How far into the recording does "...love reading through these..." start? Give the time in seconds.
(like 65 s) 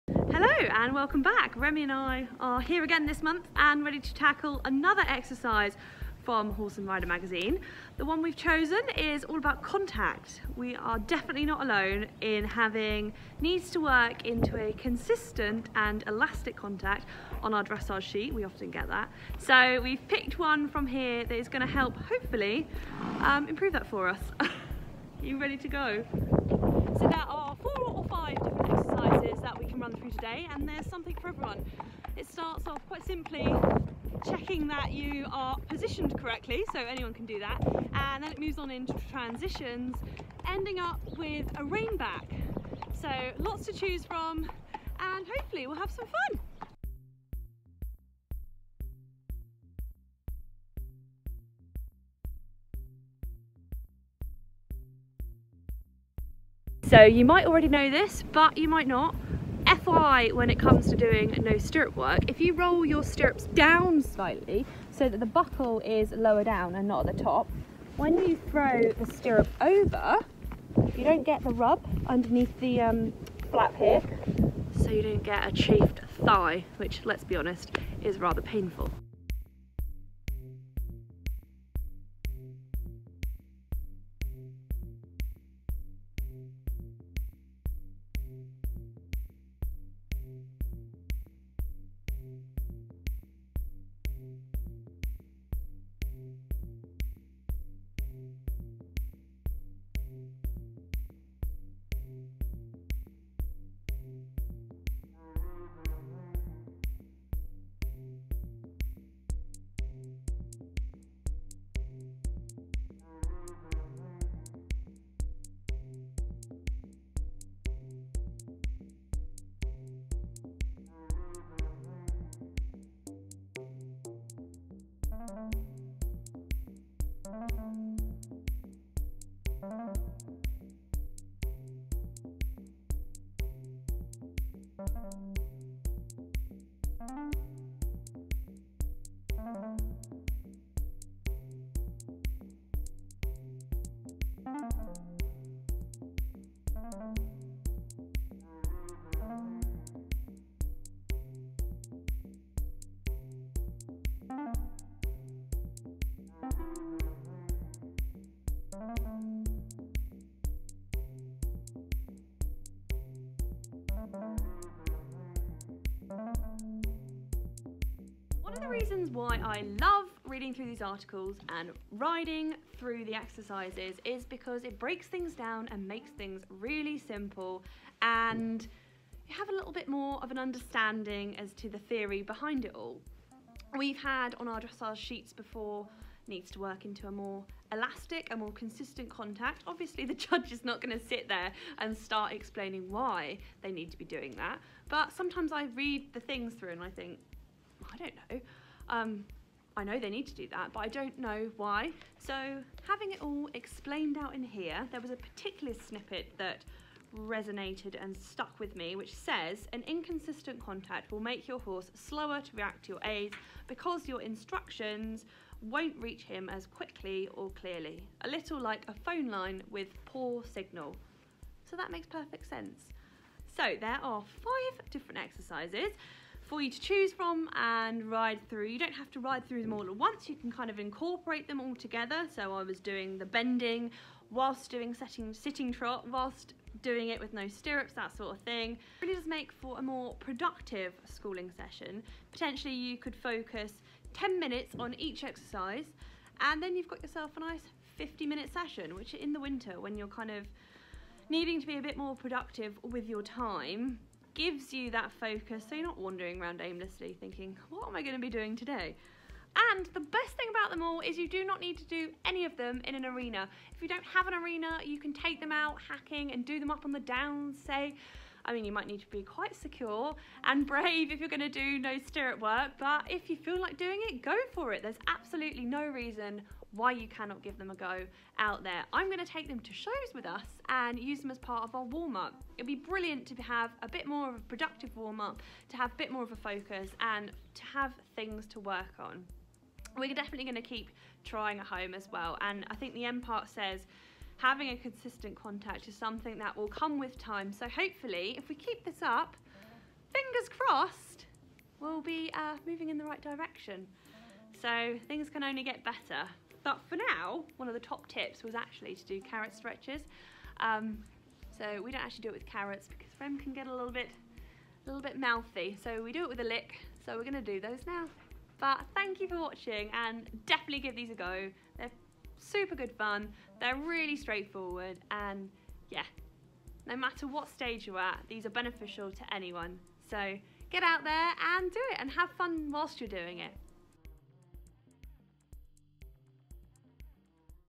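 169 s.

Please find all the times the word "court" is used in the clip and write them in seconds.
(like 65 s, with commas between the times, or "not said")
not said.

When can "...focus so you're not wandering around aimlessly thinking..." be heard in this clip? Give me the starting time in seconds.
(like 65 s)
255 s.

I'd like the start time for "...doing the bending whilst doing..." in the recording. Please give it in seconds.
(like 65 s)
232 s.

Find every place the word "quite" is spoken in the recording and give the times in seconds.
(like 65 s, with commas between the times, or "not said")
32 s, 269 s.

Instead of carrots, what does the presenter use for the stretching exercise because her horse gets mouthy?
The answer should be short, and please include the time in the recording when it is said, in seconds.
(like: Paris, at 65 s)
A lick, at 316 s.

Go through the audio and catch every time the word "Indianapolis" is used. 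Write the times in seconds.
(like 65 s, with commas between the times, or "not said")
not said.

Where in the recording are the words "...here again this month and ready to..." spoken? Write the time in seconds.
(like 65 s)
2 s.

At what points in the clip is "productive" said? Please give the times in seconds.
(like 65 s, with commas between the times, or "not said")
240 s, 252 s, 284 s.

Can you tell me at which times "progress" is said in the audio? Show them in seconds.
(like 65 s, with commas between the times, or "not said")
not said.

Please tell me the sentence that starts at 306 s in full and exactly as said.
But for now, one of the top tips was actually to do carrot stretches.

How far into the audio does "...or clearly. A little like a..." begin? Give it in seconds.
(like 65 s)
217 s.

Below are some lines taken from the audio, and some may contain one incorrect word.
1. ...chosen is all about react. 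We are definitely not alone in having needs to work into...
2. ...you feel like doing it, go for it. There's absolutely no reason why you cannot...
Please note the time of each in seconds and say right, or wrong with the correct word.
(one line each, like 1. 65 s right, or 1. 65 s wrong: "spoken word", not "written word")
1. 8 s wrong: "contact", not "react"
2. 273 s right.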